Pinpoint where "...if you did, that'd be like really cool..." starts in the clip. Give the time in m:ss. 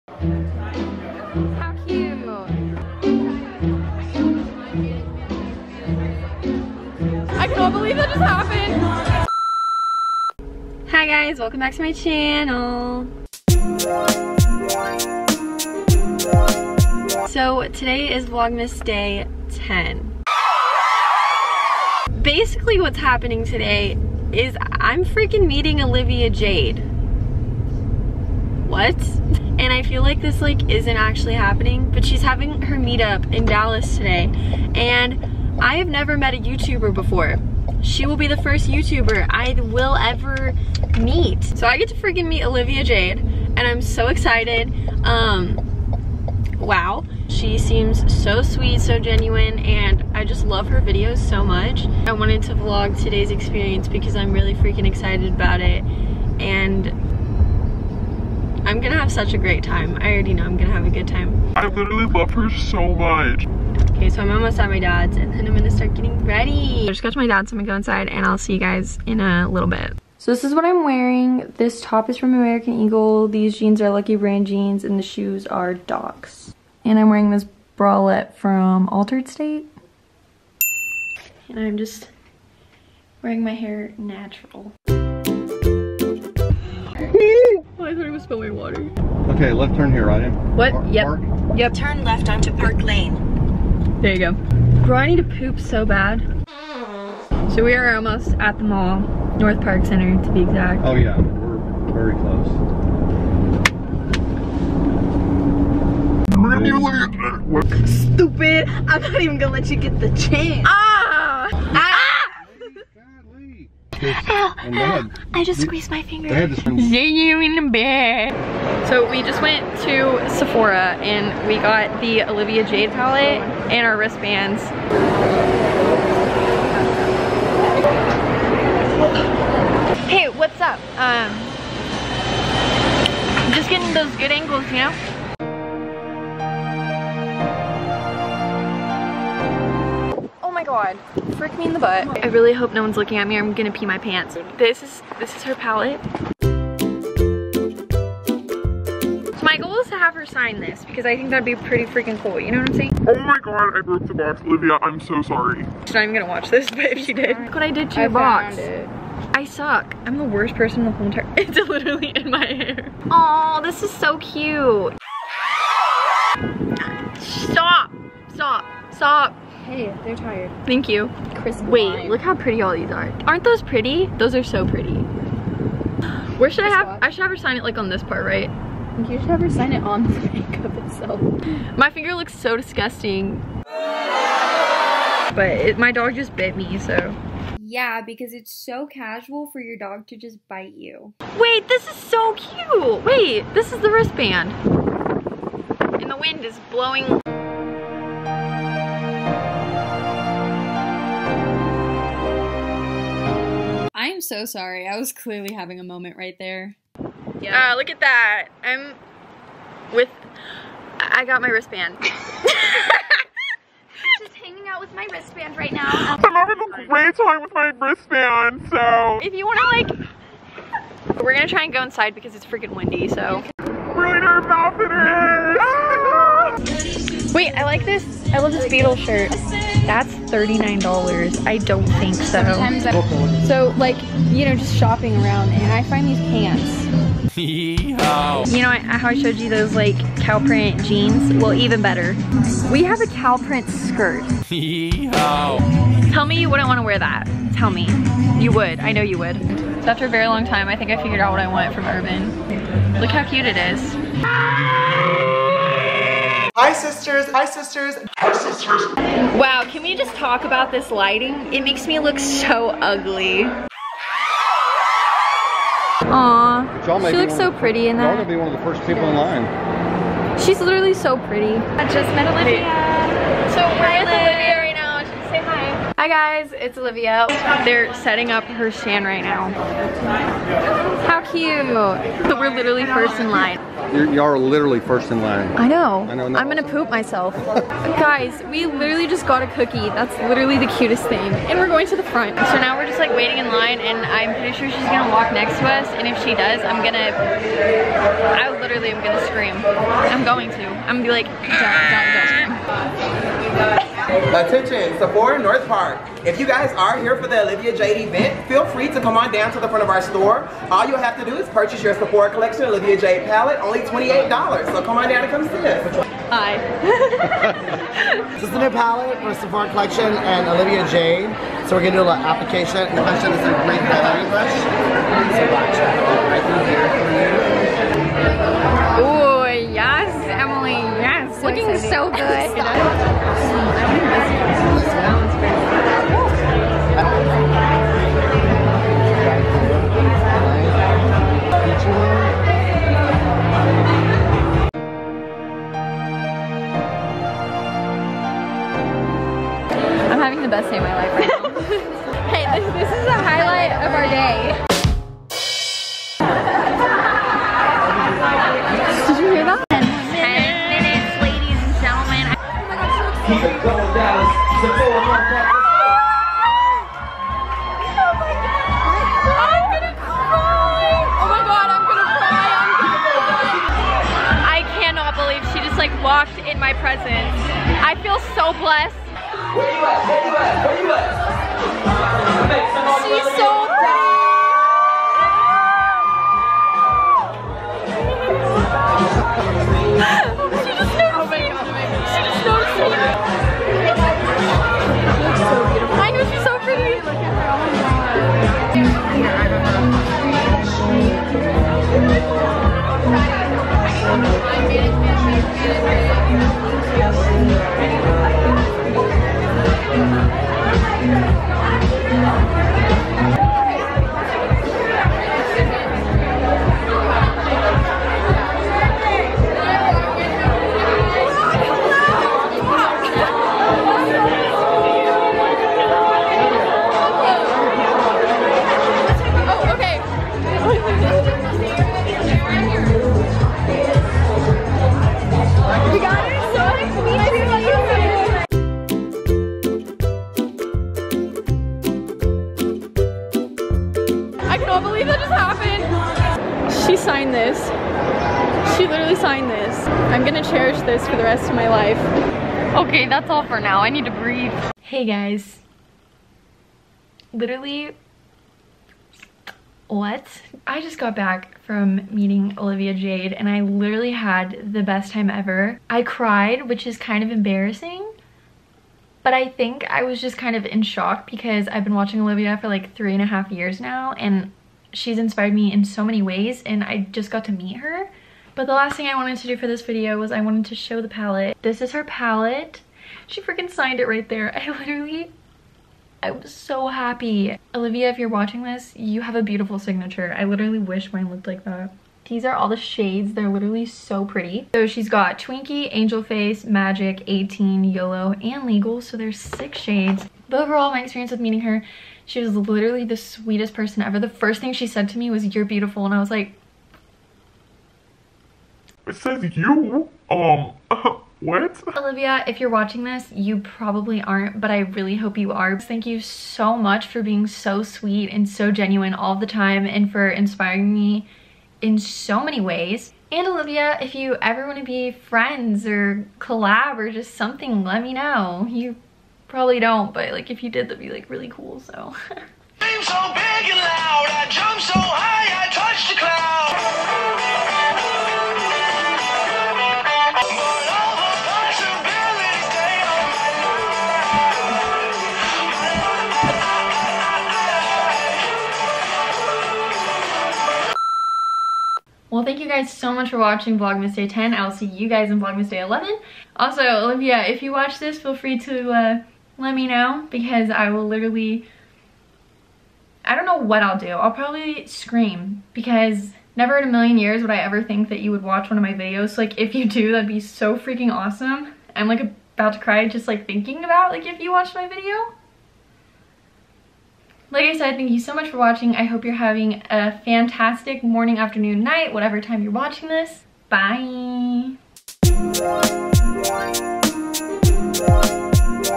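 8:50.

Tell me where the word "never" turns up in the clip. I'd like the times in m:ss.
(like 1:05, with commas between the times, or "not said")
0:35, 9:26.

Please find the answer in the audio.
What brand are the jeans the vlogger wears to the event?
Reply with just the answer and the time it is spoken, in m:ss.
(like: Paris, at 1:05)
Lucky Brand, at 1:13.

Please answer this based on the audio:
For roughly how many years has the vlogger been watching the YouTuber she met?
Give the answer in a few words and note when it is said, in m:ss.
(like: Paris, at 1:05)
three and a half, at 7:52.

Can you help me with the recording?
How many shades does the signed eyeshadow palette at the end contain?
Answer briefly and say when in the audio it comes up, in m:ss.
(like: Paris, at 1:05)
6, at 8:19.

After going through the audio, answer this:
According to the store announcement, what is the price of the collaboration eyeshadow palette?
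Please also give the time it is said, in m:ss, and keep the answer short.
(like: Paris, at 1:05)
$28, at 5:13.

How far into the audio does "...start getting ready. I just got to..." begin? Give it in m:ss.
1:05.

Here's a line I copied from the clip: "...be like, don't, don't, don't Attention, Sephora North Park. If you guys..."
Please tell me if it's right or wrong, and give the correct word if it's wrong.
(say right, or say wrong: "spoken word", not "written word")
right.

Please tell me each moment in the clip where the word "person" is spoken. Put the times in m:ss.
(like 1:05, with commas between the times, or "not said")
2:40, 8:23.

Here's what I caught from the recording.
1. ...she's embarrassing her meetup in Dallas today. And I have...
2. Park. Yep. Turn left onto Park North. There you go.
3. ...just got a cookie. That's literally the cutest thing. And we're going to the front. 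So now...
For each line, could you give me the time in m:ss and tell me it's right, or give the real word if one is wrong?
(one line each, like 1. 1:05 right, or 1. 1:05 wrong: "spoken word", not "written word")
1. 0:32 wrong: "having", not "embarrassing"
2. 1:31 wrong: "Lane", not "North"
3. 4:49 right.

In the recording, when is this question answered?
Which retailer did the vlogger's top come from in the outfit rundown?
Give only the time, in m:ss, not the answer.
1:12.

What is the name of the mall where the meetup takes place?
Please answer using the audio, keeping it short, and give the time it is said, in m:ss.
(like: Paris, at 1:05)
North Park Center, at 1:39.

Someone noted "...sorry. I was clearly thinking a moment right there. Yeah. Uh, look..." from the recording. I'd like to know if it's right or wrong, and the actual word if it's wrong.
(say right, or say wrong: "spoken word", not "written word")
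wrong: "having", not "thinking".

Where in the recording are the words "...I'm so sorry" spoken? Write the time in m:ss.
2:34.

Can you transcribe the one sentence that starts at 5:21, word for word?
So we're gonna do a little application.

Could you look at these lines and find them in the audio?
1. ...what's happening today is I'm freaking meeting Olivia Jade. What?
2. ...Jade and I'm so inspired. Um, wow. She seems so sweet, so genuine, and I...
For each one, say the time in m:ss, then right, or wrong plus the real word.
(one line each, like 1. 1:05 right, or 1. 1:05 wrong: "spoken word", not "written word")
1. 0:22 right
2. 0:42 wrong: "excited", not "inspired".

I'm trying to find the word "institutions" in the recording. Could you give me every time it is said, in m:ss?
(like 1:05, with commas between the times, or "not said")
not said.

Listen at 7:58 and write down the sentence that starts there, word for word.
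But the last thing I wanted to do for this video was I wanted to show the palette.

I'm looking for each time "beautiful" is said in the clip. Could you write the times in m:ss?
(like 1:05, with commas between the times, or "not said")
8:09, 8:25.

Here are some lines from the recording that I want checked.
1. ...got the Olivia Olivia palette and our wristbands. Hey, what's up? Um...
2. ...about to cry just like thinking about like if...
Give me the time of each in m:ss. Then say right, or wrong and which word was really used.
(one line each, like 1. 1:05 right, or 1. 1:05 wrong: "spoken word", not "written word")
1. 2:01 wrong: "Jade", not "Olivia"
2. 9:32 right.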